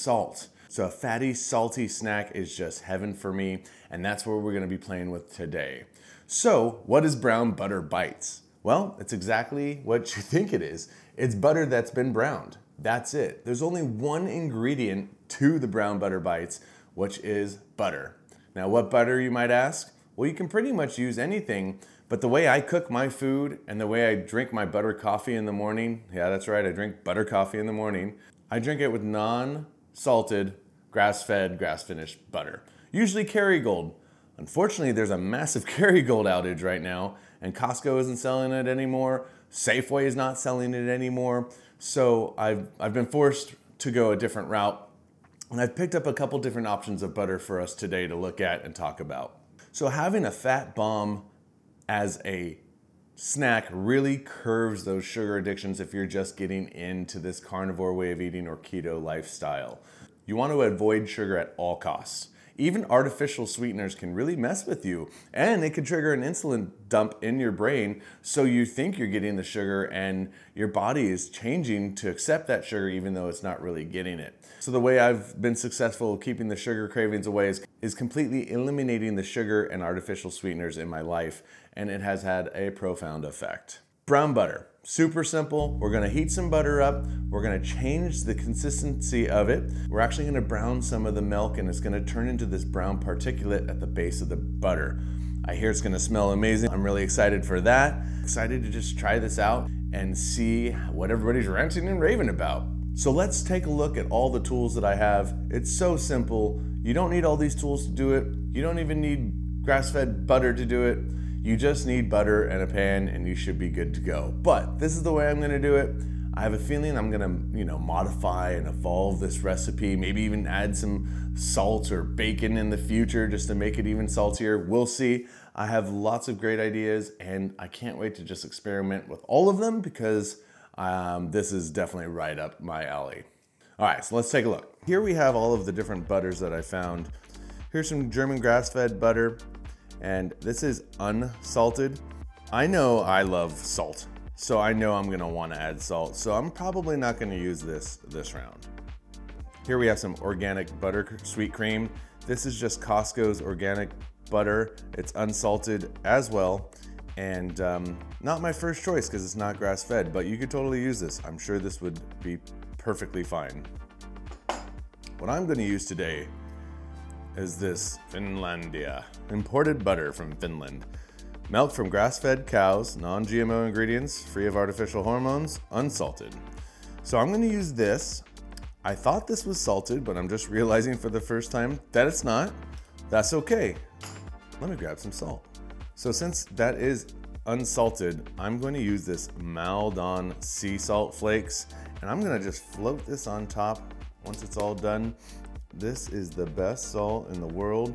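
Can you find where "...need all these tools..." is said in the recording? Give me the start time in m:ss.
1:47.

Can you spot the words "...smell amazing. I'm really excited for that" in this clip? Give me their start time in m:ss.
1:35.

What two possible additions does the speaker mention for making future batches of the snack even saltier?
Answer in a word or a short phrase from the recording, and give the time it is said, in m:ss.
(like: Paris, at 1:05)
salt or bacon, at 2:01.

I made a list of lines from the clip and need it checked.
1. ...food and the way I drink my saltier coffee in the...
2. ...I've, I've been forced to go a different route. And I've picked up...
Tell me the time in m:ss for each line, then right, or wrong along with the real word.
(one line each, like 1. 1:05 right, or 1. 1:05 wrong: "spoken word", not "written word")
1. 0:23 wrong: "butter", not "saltier"
2. 0:42 right.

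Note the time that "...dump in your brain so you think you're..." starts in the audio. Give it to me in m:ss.
1:06.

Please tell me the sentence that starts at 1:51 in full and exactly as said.
You just need butter and a pan and you should be good to go.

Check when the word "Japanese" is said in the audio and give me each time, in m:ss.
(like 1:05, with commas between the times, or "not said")
not said.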